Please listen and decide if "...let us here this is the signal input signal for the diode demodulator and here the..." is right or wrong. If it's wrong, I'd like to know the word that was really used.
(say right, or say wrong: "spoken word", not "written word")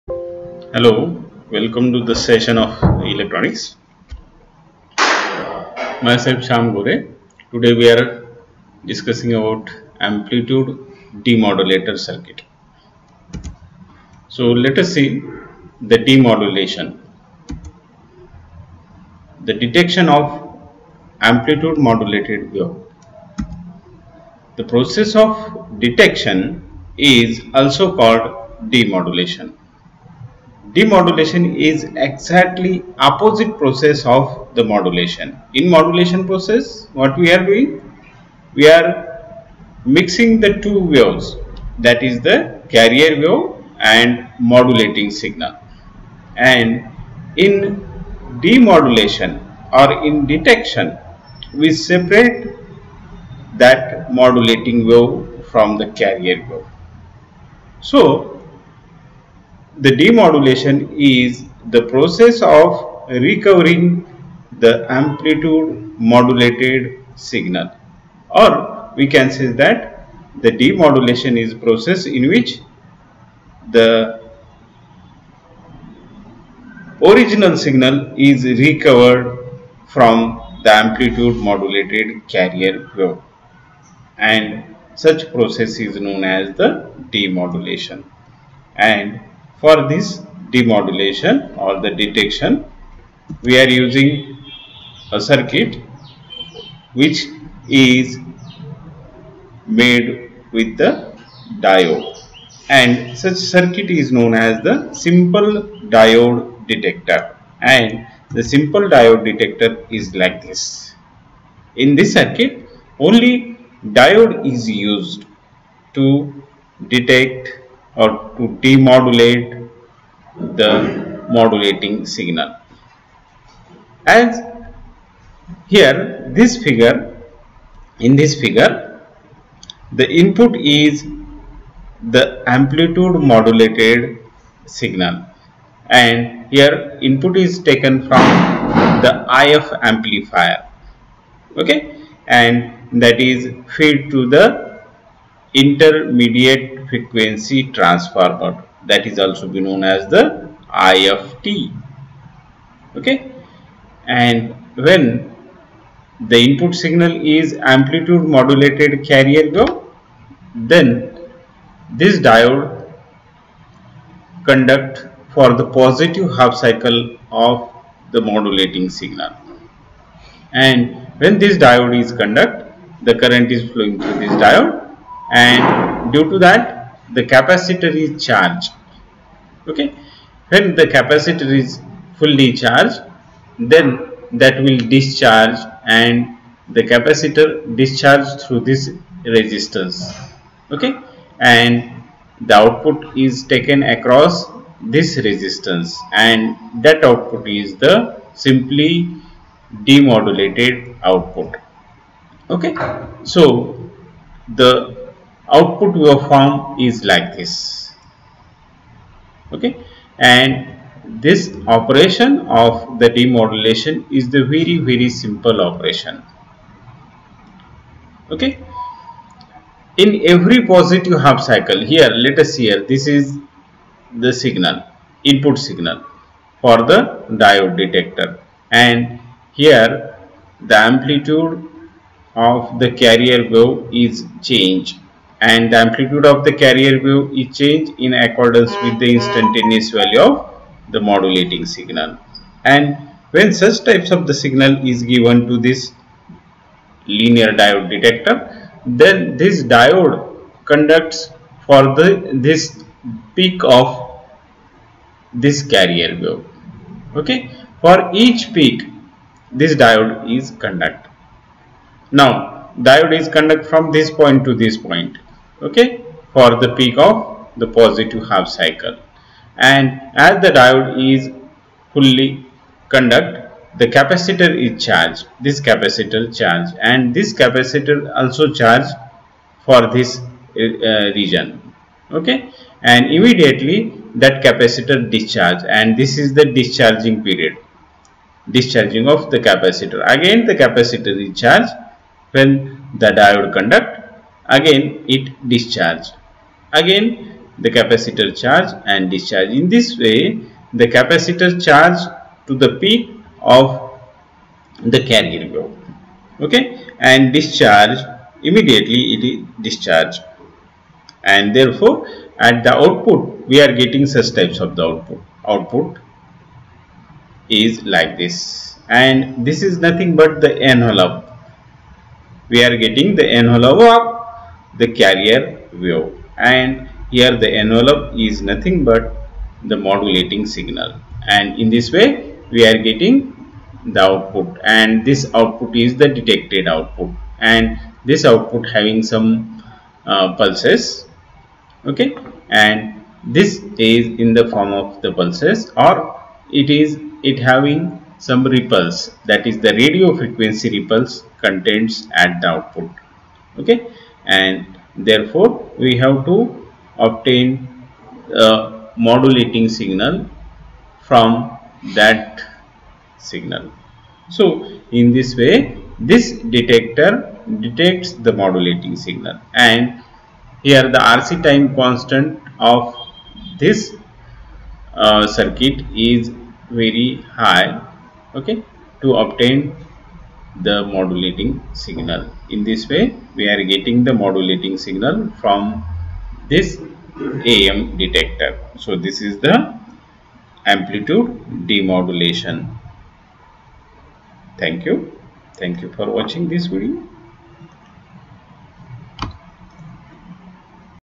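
wrong: "detector", not "demodulator".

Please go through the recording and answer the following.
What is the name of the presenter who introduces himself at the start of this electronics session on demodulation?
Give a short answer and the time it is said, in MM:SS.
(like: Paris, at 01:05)
Shyam Gore, at 00:06.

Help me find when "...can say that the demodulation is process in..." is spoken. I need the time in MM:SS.
01:09.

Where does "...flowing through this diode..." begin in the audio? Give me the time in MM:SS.
02:53.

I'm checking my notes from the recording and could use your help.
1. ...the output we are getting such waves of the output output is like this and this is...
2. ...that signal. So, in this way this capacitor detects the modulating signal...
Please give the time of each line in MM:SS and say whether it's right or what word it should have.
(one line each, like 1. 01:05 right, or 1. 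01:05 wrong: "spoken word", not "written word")
1. 05:12 wrong: "types", not "waves"
2. 06:01 wrong: "detector", not "capacitor".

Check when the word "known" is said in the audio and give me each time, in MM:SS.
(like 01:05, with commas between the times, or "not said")
01:25, 01:44, 02:29.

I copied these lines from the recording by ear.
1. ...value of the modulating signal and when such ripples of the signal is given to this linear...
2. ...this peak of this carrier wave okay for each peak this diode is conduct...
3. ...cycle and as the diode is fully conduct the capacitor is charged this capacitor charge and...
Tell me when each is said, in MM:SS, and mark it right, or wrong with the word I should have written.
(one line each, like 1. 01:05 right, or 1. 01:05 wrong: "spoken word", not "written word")
1. 03:59 wrong: "types", not "ripples"
2. 04:12 right
3. 04:28 right.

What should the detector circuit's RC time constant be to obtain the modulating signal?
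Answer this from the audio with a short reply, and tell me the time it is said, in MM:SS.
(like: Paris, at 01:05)
very high, at 06:16.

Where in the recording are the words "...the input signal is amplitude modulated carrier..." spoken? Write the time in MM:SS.
02:36.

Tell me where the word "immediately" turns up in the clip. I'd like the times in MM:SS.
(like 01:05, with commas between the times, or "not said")
04:43, 05:08.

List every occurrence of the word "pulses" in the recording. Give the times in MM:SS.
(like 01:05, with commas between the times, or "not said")
05:40, 05:45.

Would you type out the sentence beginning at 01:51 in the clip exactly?
In this circuit only diode is used to detect or to demodulate the modulating signal.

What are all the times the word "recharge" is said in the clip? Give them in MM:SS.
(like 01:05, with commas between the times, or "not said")
not said.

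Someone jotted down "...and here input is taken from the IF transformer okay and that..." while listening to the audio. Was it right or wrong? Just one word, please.
wrong.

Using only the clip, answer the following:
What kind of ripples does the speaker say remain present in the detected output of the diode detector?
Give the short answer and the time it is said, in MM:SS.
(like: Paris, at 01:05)
radio frequency ripples, at 05:49.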